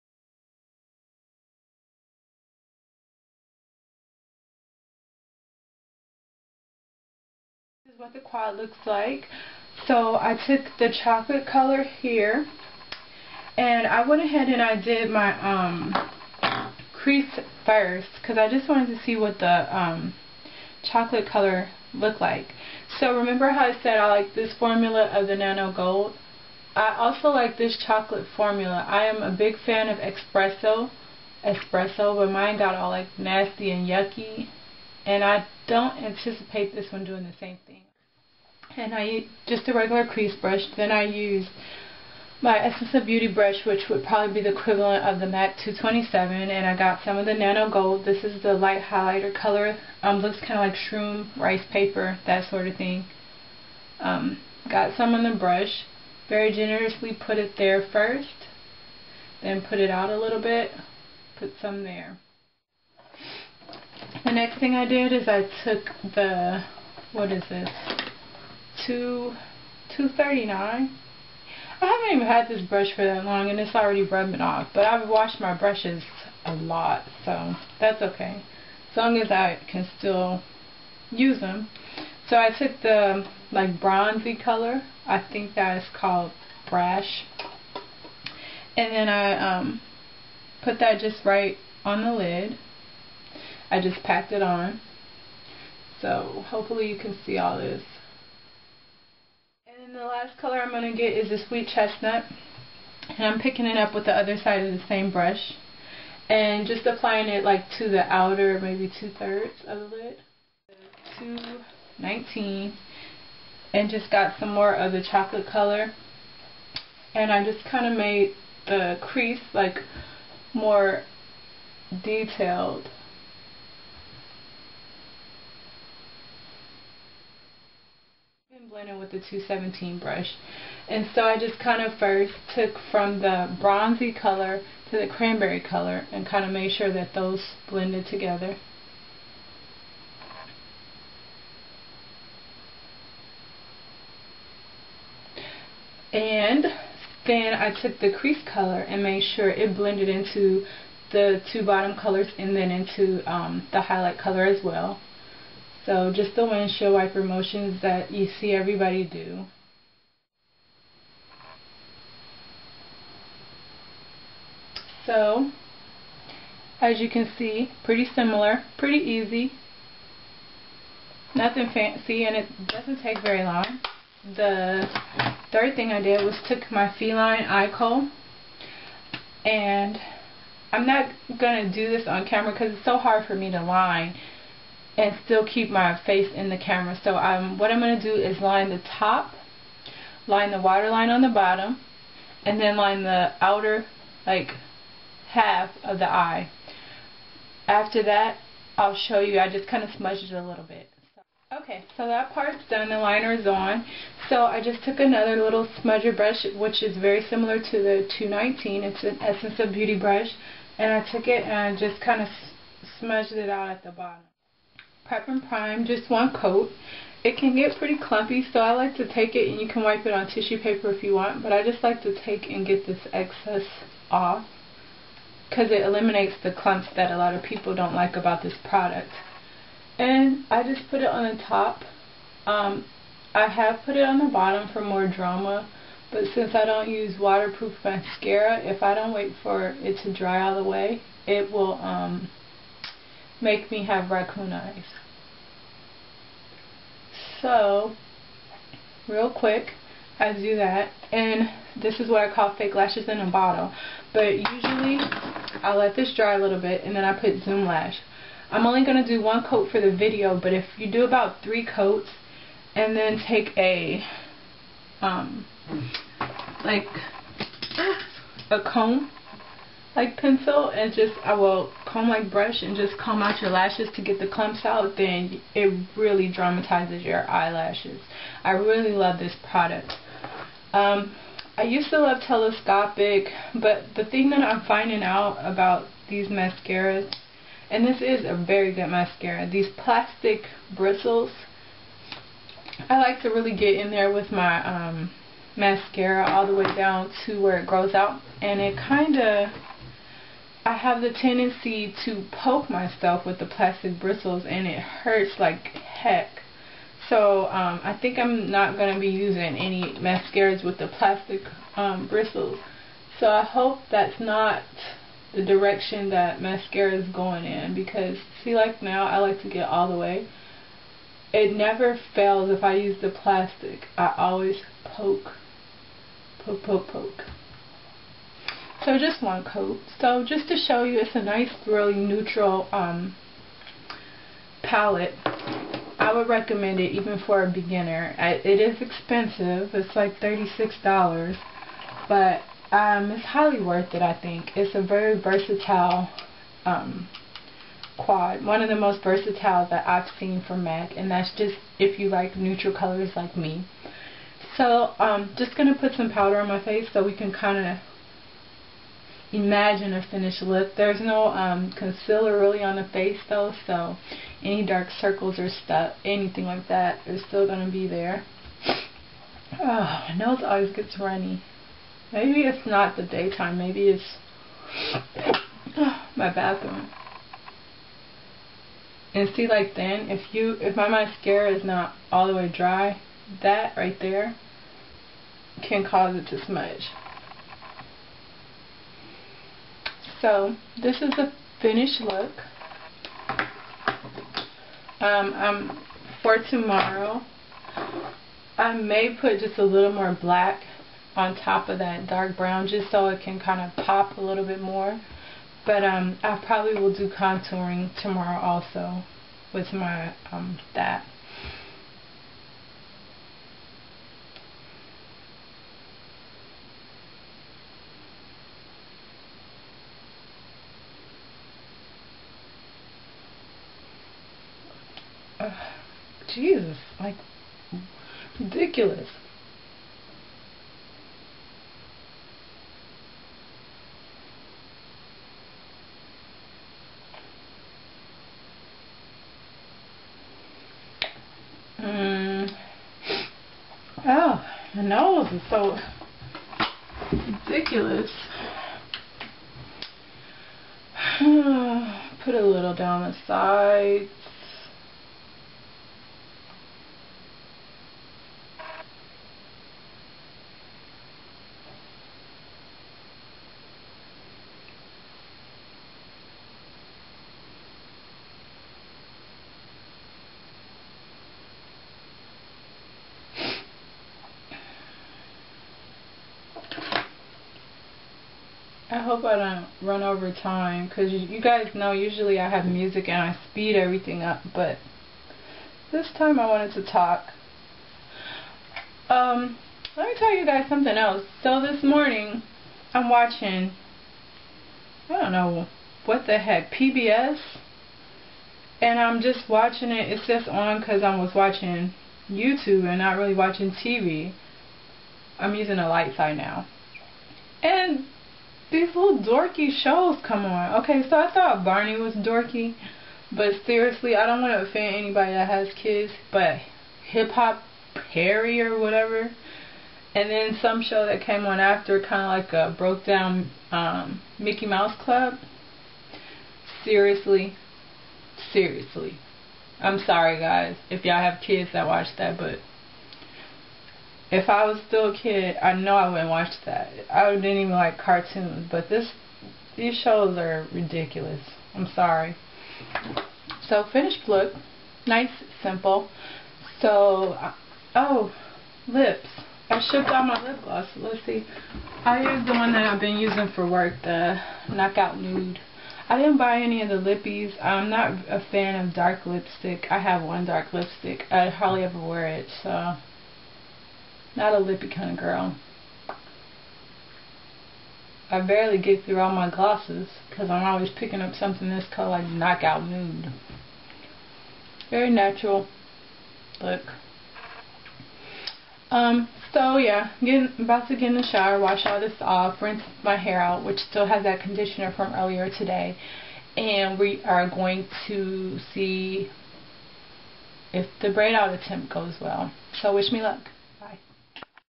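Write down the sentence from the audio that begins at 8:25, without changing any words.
I'm using a light side now.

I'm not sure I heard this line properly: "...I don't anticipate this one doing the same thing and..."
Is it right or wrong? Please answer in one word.
right.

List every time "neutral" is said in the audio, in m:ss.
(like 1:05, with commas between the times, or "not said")
5:31, 5:52.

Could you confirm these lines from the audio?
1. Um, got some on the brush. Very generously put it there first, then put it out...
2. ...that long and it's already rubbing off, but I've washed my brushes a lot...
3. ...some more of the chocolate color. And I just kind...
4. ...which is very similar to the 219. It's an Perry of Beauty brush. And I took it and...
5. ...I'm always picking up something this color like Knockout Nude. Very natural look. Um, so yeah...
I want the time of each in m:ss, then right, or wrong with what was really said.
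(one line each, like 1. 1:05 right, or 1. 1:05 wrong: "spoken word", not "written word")
1. 0:53 right
2. 1:13 right
3. 1:54 right
4. 3:26 wrong: "Essence", not "Perry"
5. 9:30 right.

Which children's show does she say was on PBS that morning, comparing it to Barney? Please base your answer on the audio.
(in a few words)
Hip Hop Perry.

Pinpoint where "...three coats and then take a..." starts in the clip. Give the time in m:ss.
4:21.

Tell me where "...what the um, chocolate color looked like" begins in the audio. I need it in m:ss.
0:19.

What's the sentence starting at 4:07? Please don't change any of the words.
So, real quick, I do that.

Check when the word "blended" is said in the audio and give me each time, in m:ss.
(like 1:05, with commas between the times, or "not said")
2:17, 2:29.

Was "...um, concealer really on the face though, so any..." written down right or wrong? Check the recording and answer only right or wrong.
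right.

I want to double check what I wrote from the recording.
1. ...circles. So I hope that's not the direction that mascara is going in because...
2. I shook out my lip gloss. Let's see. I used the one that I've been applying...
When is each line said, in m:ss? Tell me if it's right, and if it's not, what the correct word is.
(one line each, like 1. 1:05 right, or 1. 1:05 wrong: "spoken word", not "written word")
1. 5:12 wrong: "bristles", not "circles"
2. 9:09 wrong: "using", not "applying".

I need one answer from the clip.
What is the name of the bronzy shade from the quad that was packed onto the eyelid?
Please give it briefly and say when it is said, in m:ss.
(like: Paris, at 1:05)
Brash, at 1:26.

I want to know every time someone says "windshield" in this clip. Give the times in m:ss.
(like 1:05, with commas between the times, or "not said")
2:36.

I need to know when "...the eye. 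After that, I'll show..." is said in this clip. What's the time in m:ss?
3:15.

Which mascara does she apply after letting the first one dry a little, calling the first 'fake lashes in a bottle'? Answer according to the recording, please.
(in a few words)
Zoom Lash.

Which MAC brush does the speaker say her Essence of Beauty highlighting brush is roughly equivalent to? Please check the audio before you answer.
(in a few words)
MAC 227.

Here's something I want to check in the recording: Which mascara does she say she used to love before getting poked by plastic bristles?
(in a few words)
Telescopic.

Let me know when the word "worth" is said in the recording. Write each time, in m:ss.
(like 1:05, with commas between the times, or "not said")
5:43.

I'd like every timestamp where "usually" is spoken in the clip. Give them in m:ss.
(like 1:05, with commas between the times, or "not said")
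4:14, 8:01.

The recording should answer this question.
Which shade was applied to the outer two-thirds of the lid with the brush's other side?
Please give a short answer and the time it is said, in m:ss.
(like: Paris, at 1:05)
Sweet Chestnut, at 1:41.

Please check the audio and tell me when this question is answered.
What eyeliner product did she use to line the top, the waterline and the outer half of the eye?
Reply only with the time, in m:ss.
2:56.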